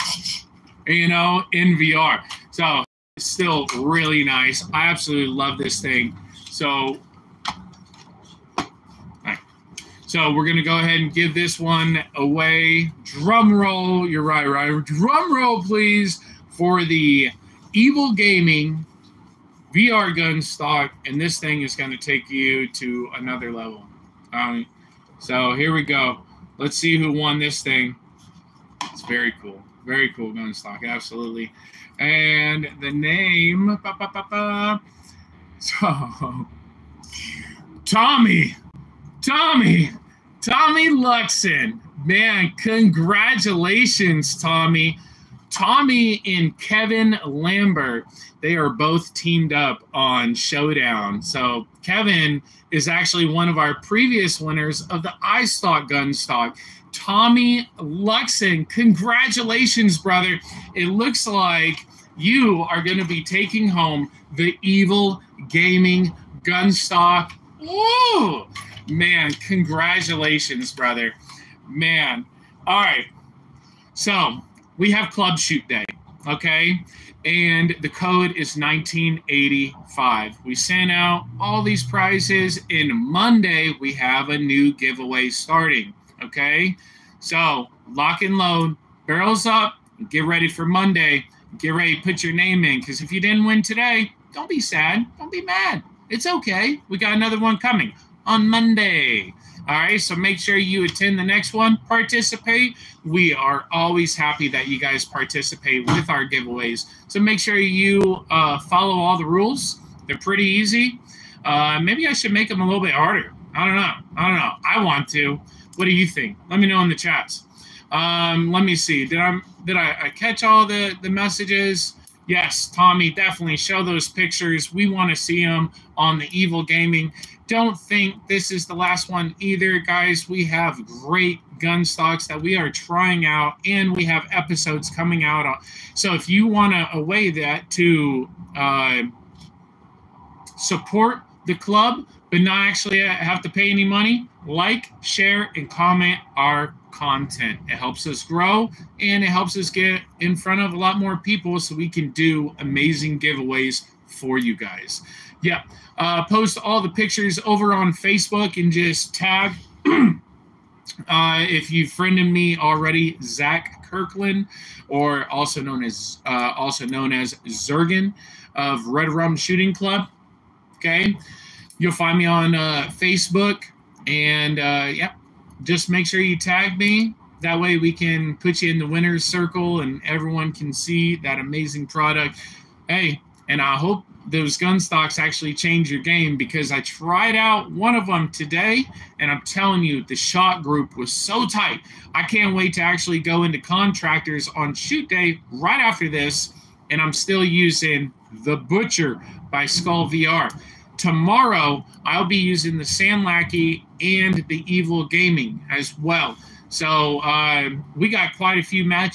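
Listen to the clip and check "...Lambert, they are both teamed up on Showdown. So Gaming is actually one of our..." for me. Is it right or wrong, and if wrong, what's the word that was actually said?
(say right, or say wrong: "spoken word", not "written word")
wrong: "Kevin", not "Gaming".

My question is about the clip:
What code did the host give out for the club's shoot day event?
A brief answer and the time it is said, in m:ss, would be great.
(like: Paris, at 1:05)
1985, at 1:18.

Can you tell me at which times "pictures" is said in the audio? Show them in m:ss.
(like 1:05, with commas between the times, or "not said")
2:04, 2:36.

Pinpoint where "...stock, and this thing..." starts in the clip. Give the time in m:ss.
0:20.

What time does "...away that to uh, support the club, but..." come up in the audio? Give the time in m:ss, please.
2:16.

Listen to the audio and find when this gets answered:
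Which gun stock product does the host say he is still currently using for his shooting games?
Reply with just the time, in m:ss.
3:18.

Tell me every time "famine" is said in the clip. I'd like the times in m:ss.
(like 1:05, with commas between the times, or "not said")
not said.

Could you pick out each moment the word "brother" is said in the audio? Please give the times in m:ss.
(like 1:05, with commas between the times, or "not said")
0:59, 1:10.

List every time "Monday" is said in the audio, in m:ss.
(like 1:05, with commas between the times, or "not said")
1:22, 1:30, 1:38.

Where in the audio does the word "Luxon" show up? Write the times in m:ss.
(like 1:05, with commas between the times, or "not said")
0:40, 0:57.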